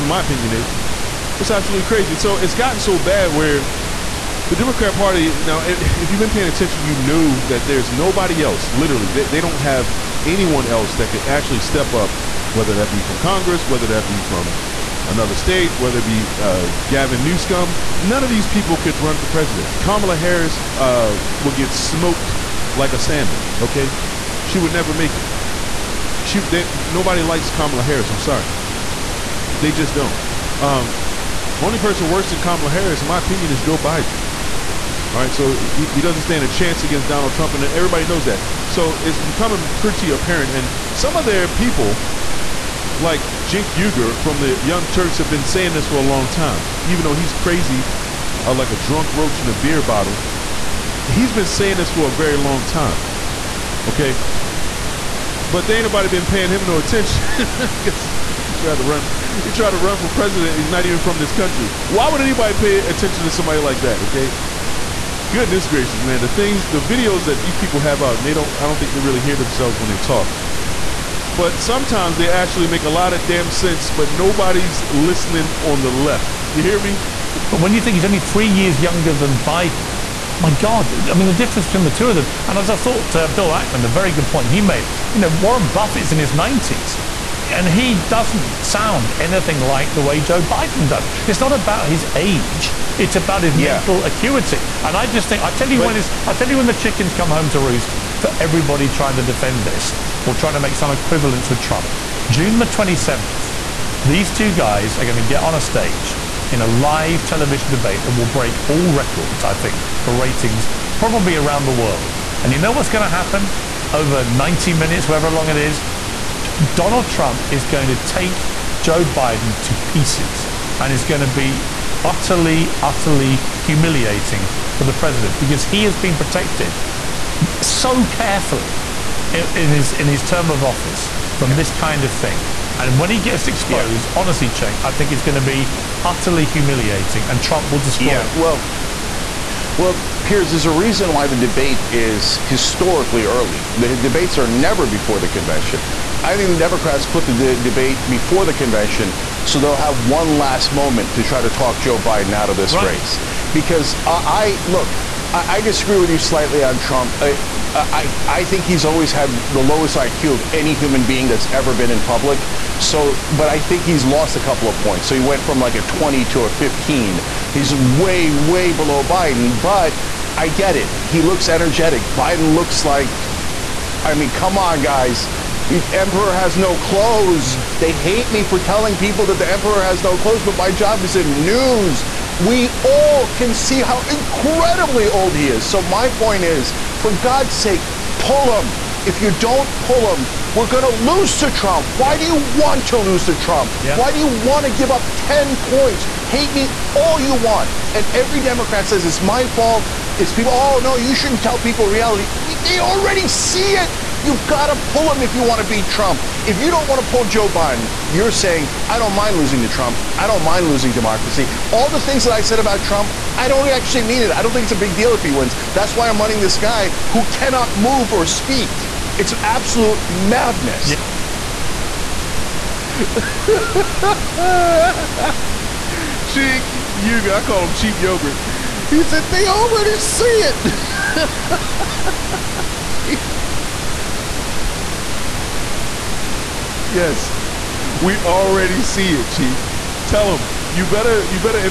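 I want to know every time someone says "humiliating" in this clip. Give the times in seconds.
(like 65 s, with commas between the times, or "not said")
123 s, 136 s.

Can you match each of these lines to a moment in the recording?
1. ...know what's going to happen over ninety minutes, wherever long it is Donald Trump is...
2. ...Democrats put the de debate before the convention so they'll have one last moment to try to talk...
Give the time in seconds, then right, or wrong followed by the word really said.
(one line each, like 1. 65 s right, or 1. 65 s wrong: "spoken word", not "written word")
1. 112 s right
2. 146 s right.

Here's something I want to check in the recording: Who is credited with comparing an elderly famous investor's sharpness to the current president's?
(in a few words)
Bill Ackman.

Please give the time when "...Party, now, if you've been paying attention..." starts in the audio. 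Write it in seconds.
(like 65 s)
4 s.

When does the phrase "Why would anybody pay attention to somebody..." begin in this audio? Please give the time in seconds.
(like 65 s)
61 s.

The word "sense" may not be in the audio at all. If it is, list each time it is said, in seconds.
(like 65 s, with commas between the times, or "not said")
73 s.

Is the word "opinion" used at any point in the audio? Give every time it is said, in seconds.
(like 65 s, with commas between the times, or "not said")
0 s, 33 s.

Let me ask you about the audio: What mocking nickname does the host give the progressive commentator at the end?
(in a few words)
cheap yogurt.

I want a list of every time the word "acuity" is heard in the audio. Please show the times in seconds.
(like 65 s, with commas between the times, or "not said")
94 s.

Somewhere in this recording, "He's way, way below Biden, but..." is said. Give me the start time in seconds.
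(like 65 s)
167 s.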